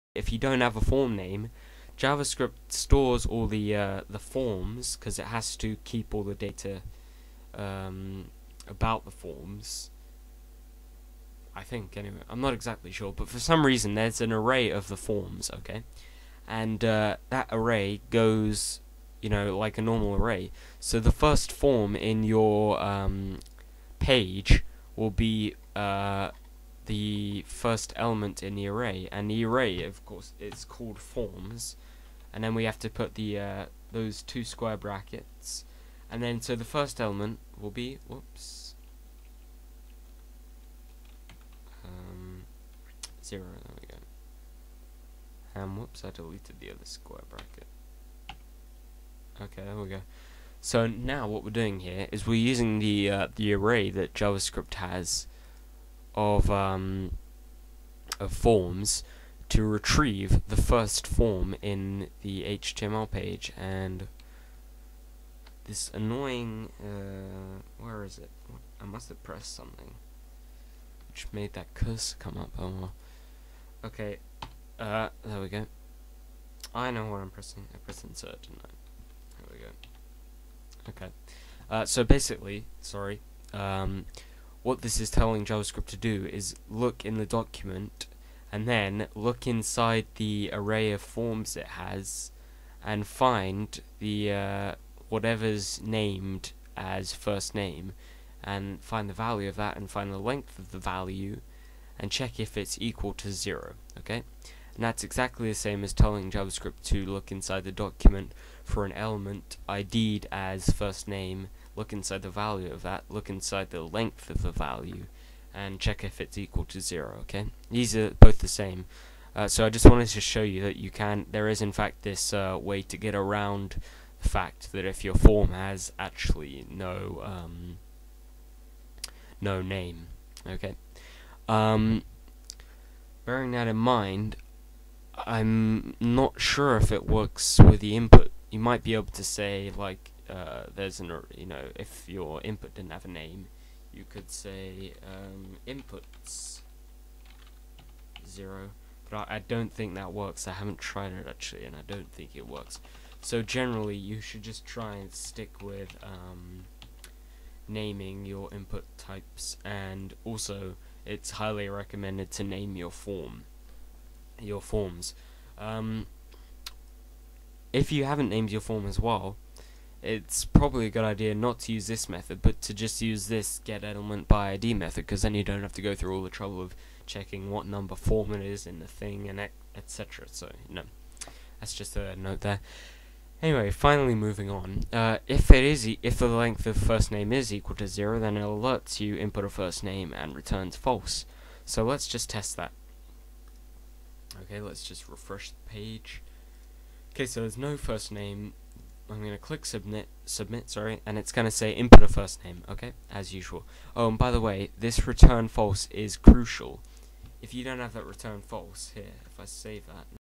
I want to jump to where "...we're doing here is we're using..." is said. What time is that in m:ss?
0:51.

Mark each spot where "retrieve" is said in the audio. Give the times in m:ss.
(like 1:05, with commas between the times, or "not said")
0:59.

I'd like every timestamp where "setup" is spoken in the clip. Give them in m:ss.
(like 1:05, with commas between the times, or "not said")
not said.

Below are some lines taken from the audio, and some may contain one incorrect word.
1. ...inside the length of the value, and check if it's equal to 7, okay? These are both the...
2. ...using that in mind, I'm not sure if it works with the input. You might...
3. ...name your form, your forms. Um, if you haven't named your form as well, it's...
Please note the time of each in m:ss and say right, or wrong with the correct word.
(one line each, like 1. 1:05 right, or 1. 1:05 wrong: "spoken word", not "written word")
1. 1:53 wrong: "0", not "7"
2. 2:13 wrong: "bearing", not "using"
3. 2:42 right.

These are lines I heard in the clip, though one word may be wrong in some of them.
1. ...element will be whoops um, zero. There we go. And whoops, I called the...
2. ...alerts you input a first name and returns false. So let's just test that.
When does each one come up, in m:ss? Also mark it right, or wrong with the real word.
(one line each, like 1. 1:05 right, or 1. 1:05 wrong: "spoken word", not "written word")
1. 0:36 wrong: "deleted", not "called"
2. 3:08 right.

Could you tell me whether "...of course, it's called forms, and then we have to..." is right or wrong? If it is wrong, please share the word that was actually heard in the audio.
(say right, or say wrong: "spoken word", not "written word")
right.